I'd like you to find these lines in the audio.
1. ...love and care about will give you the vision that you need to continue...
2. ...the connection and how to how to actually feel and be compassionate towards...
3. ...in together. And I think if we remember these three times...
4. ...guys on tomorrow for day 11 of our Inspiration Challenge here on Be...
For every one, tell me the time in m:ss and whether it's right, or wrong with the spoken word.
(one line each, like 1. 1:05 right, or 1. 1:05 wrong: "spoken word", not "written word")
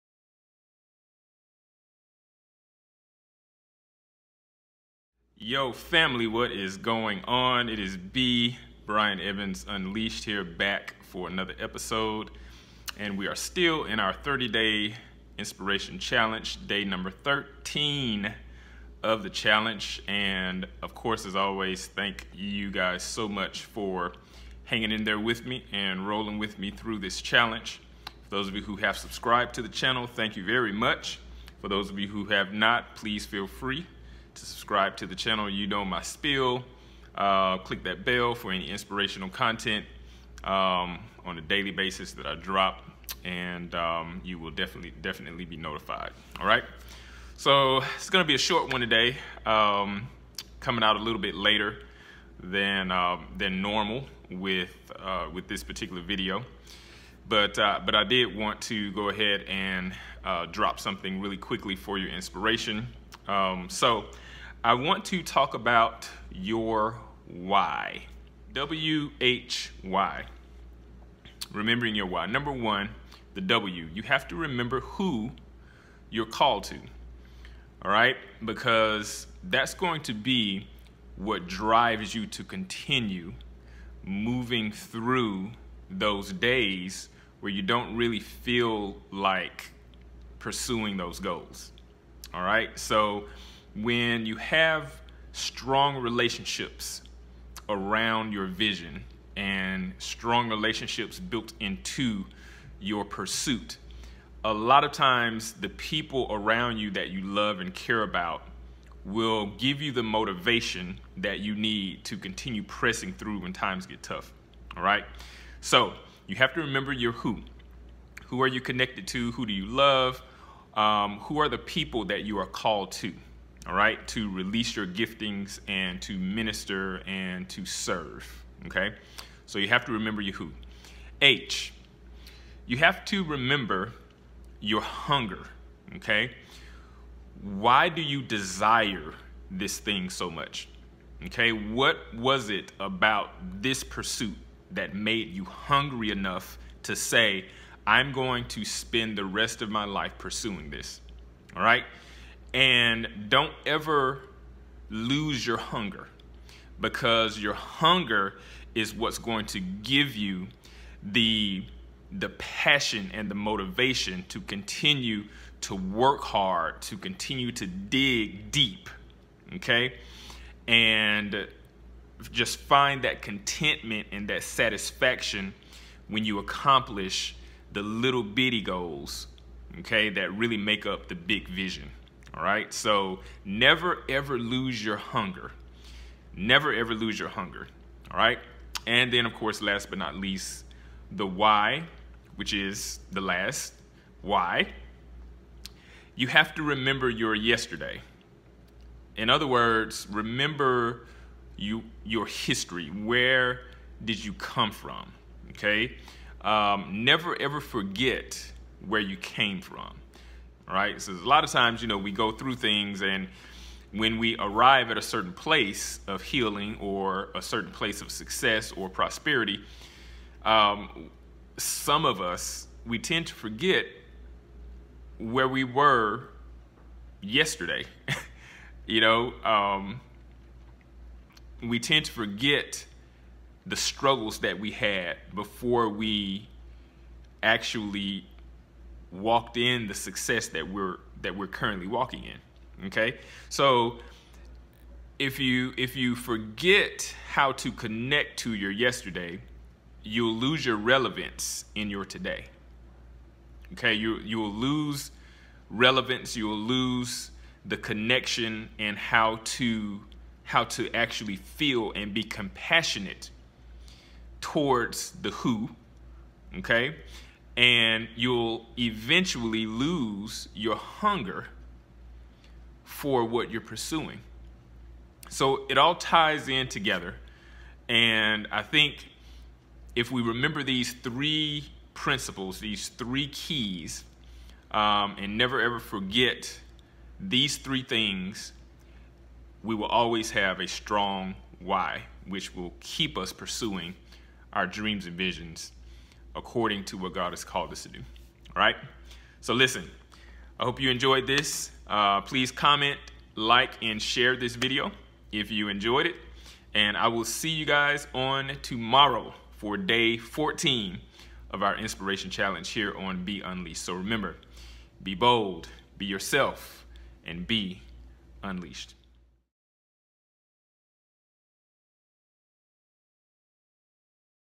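1. 1:47 wrong: "motivation", not "vision"
2. 4:17 right
3. 4:36 wrong: "principles", not "times"
4. 5:07 wrong: "14", not "11".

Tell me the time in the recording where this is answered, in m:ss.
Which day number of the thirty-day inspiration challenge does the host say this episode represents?
0:16.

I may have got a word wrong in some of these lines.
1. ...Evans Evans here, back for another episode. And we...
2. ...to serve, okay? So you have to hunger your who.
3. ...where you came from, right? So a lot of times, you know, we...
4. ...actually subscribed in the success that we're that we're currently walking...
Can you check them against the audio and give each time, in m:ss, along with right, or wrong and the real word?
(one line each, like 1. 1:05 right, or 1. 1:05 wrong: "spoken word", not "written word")
1. 0:09 wrong: "Unleashed", not "Evans"
2. 2:07 wrong: "remember", not "hunger"
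3. 3:28 right
4. 3:57 wrong: "walked", not "subscribed".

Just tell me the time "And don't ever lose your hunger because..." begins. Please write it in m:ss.
2:32.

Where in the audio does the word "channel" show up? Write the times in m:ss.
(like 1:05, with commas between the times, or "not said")
0:29, 0:35.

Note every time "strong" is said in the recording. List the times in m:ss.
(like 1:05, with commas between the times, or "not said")
1:35, 1:39, 4:50.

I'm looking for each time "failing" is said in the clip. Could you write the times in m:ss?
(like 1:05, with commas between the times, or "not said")
not said.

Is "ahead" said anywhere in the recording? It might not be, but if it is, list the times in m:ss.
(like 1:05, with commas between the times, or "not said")
0:59.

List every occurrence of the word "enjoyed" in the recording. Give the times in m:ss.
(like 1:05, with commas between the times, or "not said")
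5:00, 5:05.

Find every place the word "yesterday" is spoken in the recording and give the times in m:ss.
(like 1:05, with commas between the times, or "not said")
3:17, 3:47, 4:08.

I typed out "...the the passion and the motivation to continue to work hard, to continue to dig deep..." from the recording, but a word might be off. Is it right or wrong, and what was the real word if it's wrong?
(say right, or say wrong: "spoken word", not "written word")
right.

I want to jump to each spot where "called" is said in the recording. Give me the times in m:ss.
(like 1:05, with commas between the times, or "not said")
1:16, 2:02, 4:57.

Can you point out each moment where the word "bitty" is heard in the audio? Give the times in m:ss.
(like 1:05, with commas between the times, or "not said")
2:58.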